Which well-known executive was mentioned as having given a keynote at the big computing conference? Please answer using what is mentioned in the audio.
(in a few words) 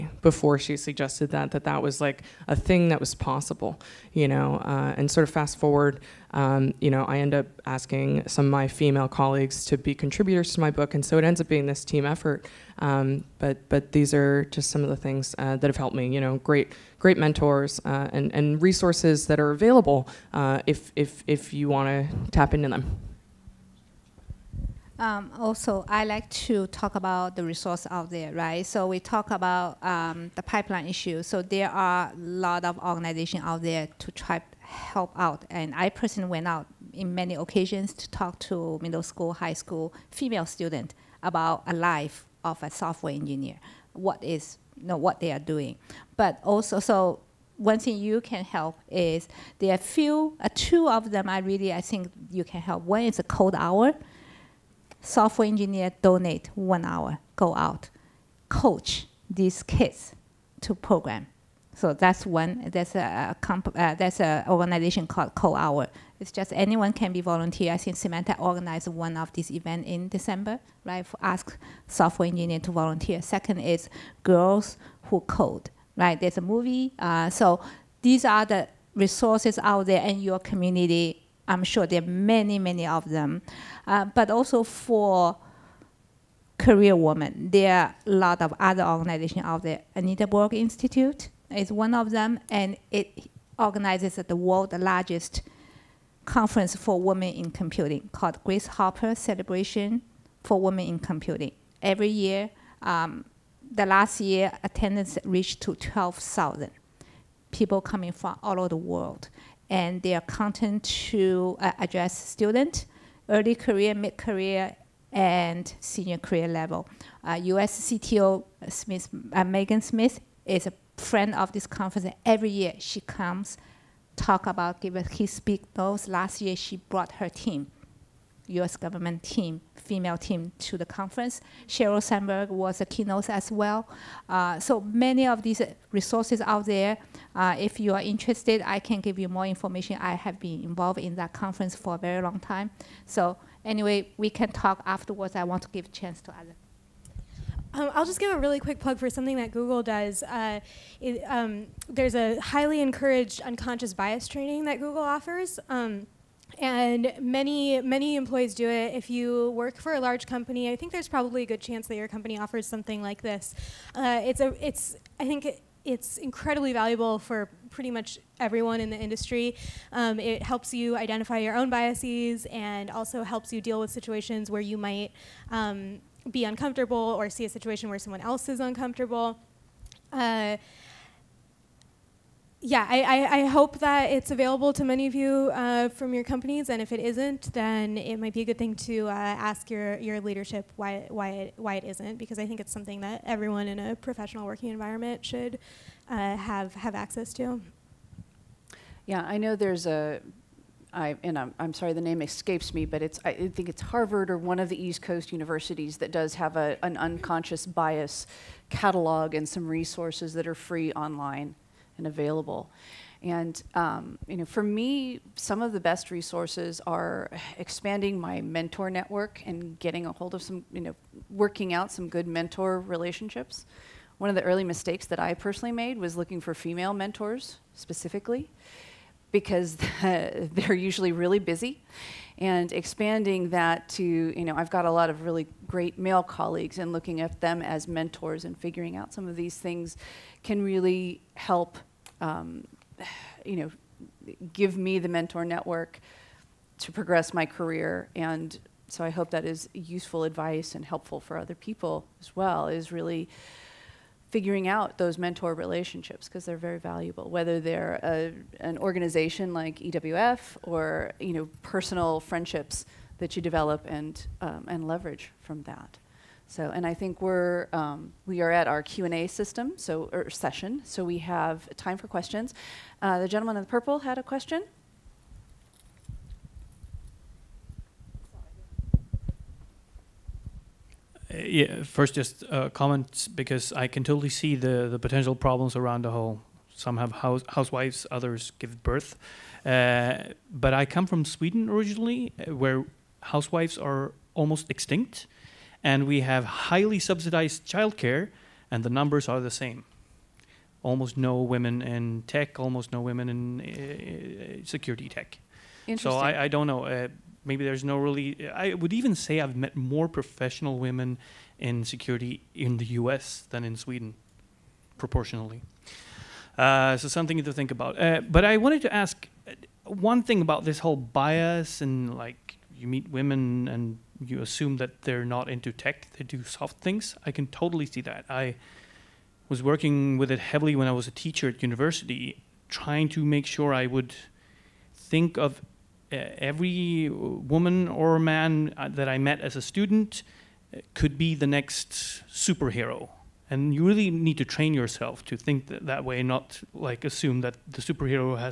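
Sheryl Sandberg.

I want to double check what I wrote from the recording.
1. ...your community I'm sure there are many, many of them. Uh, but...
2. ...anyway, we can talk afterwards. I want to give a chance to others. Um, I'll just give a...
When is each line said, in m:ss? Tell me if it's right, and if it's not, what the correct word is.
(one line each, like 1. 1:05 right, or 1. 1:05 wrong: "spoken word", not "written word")
1. 1:20 right
2. 2:23 right.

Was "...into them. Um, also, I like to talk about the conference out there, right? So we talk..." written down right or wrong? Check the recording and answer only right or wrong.
wrong.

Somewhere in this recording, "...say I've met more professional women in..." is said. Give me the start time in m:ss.
5:09.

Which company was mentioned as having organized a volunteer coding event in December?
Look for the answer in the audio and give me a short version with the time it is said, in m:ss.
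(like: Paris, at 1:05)
Symantec, at 1:07.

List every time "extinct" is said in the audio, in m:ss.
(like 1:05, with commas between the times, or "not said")
4:54.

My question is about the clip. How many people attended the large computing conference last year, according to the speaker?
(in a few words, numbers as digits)
12,000.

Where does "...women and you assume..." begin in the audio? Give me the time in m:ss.
5:23.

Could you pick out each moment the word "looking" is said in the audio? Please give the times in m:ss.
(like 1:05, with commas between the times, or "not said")
3:46, 3:56.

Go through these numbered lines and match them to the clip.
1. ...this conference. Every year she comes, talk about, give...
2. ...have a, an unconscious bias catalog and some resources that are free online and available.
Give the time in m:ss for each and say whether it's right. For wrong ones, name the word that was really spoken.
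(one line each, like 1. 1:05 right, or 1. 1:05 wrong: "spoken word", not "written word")
1. 2:01 right
2. 3:26 right.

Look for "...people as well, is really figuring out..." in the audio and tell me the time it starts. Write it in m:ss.
4:11.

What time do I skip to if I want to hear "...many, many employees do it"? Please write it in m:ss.
2:37.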